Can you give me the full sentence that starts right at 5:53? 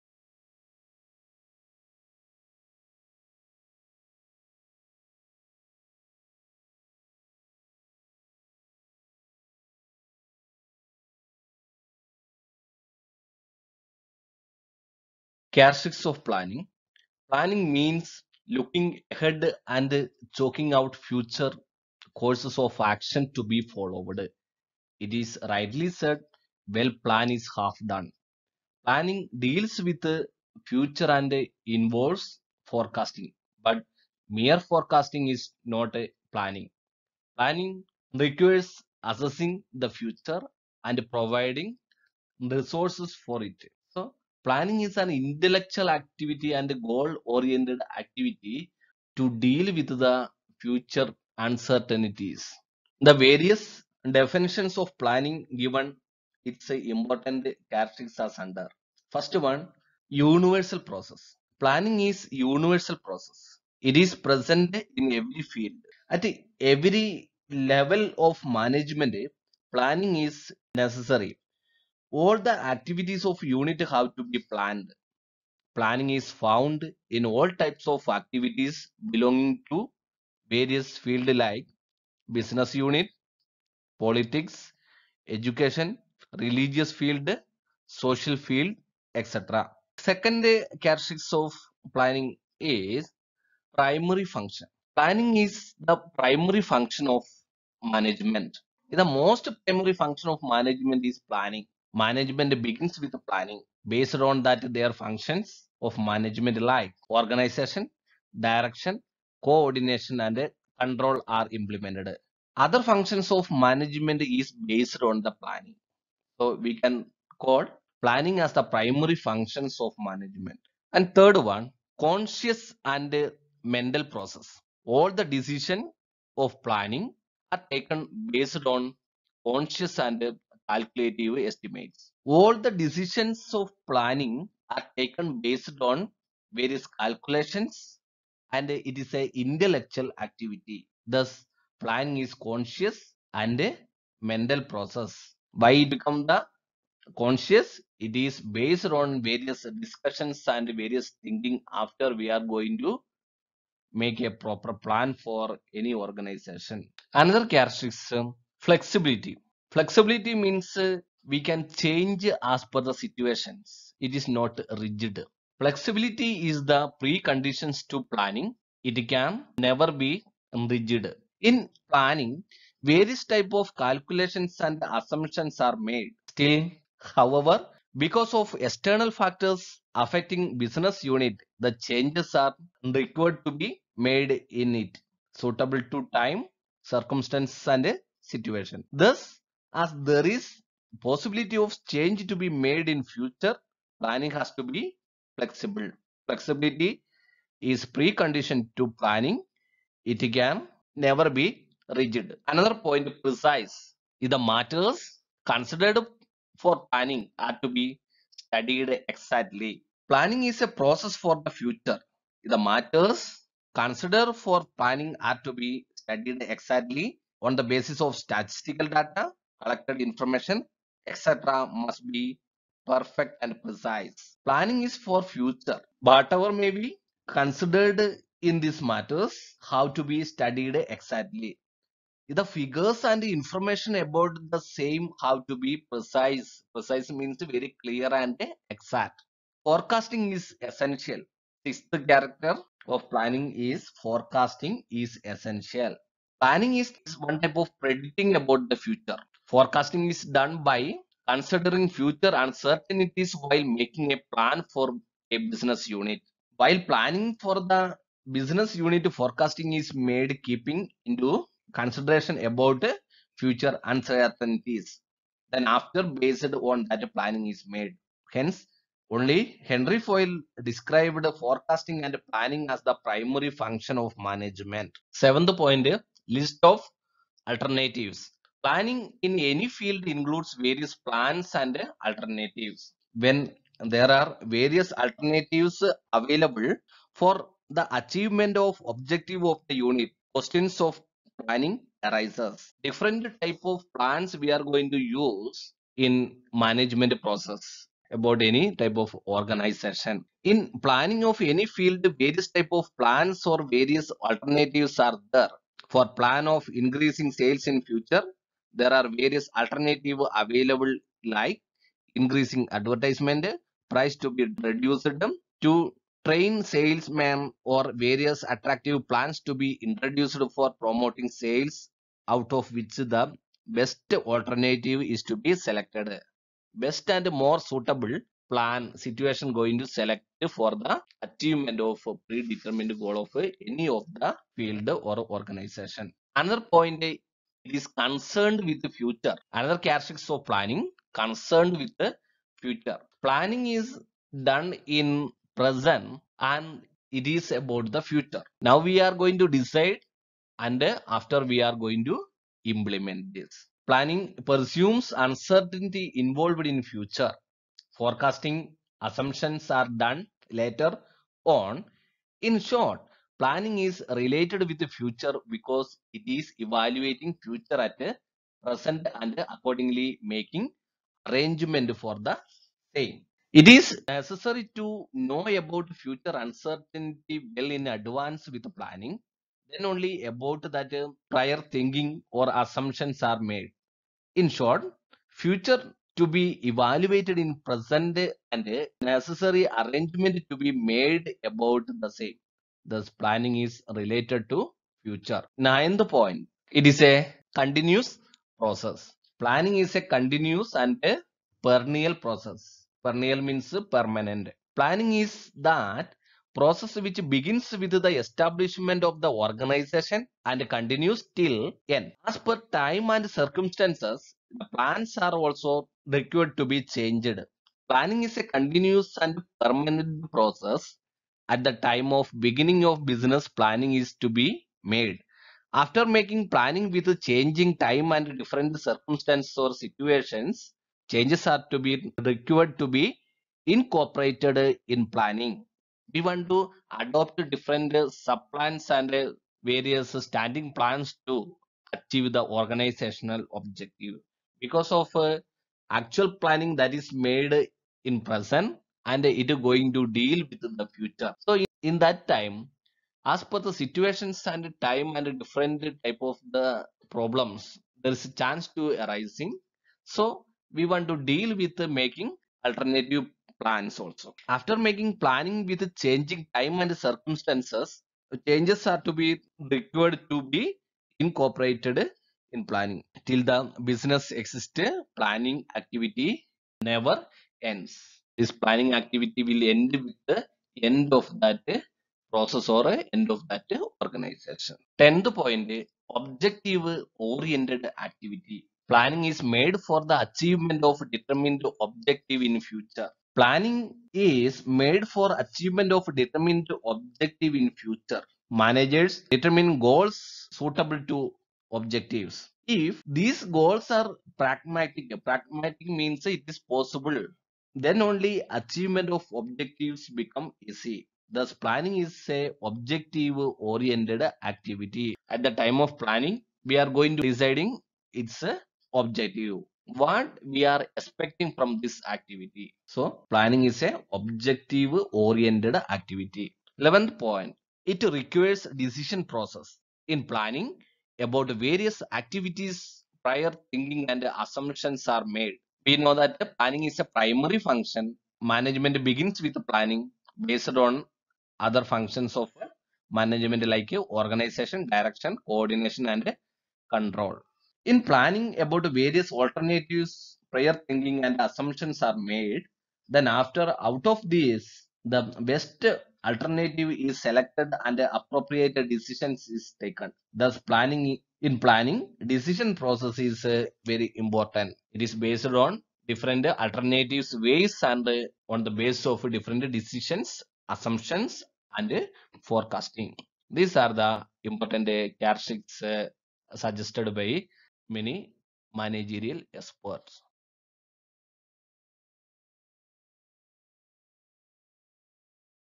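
Planning presumes uncertainty involved in future.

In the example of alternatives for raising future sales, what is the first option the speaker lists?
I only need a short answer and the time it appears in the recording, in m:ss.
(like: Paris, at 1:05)
increasing advertisement, at 5:12.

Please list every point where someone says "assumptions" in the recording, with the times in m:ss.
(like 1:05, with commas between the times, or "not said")
2:54, 5:59, 6:22, 8:54, 9:11, 9:30.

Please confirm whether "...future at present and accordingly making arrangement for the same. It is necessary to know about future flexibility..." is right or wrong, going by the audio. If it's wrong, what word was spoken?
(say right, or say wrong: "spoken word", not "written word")
wrong: "uncertainty", not "flexibility".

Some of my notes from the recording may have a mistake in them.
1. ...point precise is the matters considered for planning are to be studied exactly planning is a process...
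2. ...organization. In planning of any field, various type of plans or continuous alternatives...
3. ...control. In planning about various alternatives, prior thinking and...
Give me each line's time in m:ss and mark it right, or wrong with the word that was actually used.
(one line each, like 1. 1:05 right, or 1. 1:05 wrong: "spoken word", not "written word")
1. 3:22 right
2. 4:59 wrong: "various", not "continuous"
3. 9:06 right.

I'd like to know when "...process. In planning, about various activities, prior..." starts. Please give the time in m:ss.
8:49.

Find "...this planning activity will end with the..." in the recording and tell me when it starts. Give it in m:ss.
7:58.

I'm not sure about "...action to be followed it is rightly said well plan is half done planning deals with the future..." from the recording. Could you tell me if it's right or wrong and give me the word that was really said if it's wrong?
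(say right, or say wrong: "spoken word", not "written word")
right.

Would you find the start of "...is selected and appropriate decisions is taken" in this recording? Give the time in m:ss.
9:16.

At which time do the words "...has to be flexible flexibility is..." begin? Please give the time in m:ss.
3:14.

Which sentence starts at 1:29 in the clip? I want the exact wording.
Second characteristics of planning is primary function.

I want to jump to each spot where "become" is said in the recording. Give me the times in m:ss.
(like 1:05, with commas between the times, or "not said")
2:25, 8:30.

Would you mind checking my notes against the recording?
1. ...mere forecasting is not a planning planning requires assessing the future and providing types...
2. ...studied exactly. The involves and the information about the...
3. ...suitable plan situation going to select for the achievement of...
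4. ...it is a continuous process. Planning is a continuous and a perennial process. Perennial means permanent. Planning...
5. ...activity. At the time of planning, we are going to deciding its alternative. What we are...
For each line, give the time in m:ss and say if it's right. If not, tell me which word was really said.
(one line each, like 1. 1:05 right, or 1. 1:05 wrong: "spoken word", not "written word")
1. 0:34 wrong: "resources", not "types"
2. 3:50 wrong: "figures", not "involves"
3. 5:27 right
4. 6:36 right
5. 8:34 wrong: "objective", not "alternative".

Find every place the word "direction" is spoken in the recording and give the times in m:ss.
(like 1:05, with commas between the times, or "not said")
1:48, 9:04.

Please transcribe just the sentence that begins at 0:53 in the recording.
The various definitions of planning given its important characteristics under.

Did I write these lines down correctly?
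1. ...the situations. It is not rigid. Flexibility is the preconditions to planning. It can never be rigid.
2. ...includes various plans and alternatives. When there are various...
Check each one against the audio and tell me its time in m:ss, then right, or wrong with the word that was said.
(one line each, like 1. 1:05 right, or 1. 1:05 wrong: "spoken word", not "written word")
1. 2:42 right
2. 4:40 right.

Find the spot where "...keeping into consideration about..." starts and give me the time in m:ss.
4:20.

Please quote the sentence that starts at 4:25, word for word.
Then after based on that planning is made.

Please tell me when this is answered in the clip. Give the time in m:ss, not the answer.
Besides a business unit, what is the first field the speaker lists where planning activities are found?
1:23.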